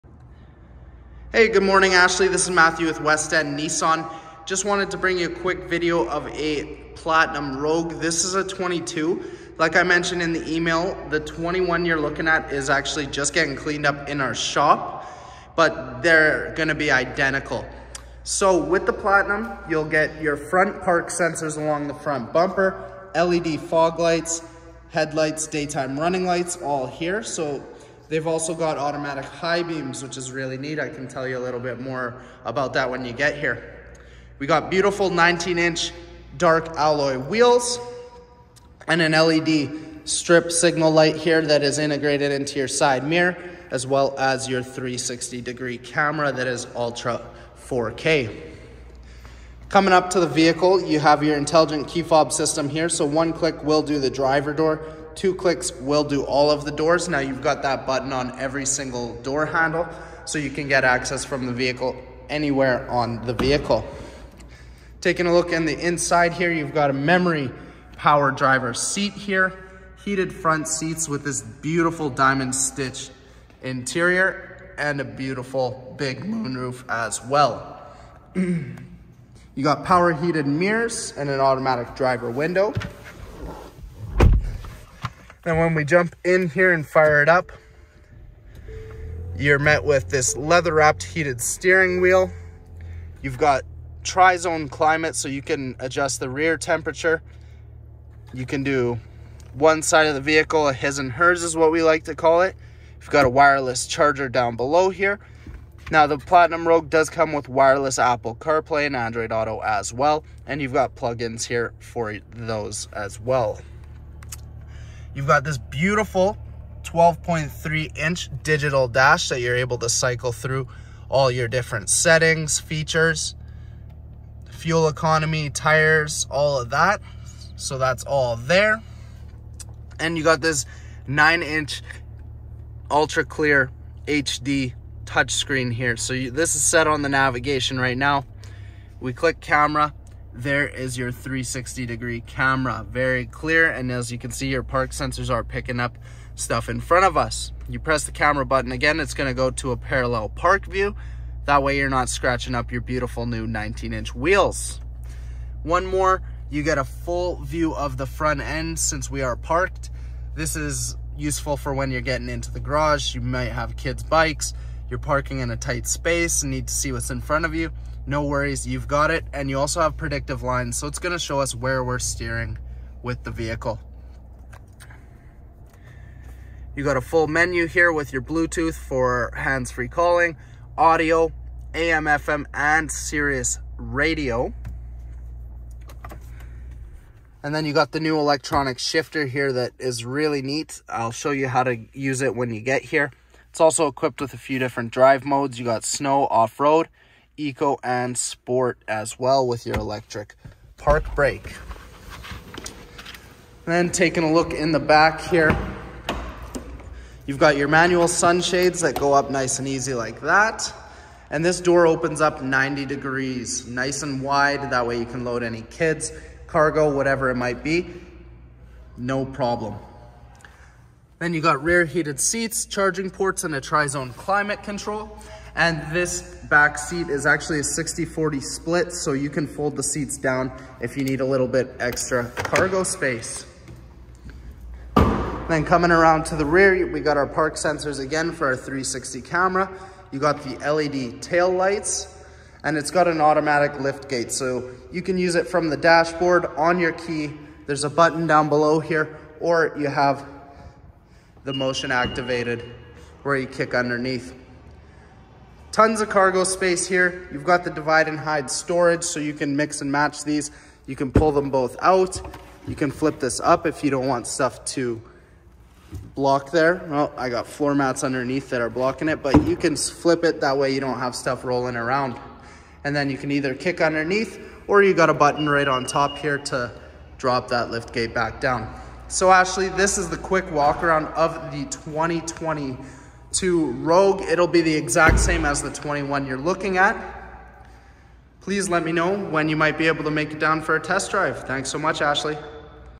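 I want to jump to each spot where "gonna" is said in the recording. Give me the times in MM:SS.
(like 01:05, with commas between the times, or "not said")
00:16, 02:50.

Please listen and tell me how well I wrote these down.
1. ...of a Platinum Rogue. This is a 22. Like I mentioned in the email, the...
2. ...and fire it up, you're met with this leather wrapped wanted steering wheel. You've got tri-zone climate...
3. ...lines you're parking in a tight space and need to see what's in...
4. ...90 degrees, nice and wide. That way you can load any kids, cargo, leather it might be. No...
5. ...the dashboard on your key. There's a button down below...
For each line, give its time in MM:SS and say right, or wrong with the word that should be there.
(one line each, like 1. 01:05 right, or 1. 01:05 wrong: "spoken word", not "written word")
1. 00:06 right
2. 01:26 wrong: "heated", not "wanted"
3. 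02:44 wrong: "bikes", not "lines"
4. 03:32 wrong: "whatever", not "leather"
5. 04:05 right.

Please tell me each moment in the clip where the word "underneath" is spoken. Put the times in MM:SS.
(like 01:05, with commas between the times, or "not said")
04:13, 04:28, 04:33.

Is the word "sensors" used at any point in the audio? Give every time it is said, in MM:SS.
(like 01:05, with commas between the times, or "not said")
00:21, 02:24, 03:57.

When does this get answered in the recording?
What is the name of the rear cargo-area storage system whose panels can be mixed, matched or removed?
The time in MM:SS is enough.
04:17.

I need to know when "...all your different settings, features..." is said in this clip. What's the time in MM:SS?
02:01.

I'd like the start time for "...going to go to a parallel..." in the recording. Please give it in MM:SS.
02:29.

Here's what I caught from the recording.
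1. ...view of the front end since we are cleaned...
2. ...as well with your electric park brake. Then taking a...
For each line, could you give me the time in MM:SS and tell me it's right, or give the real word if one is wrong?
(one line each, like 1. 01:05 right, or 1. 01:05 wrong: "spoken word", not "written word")
1. 02:37 wrong: "parked", not "cleaned"
2. 03:18 right.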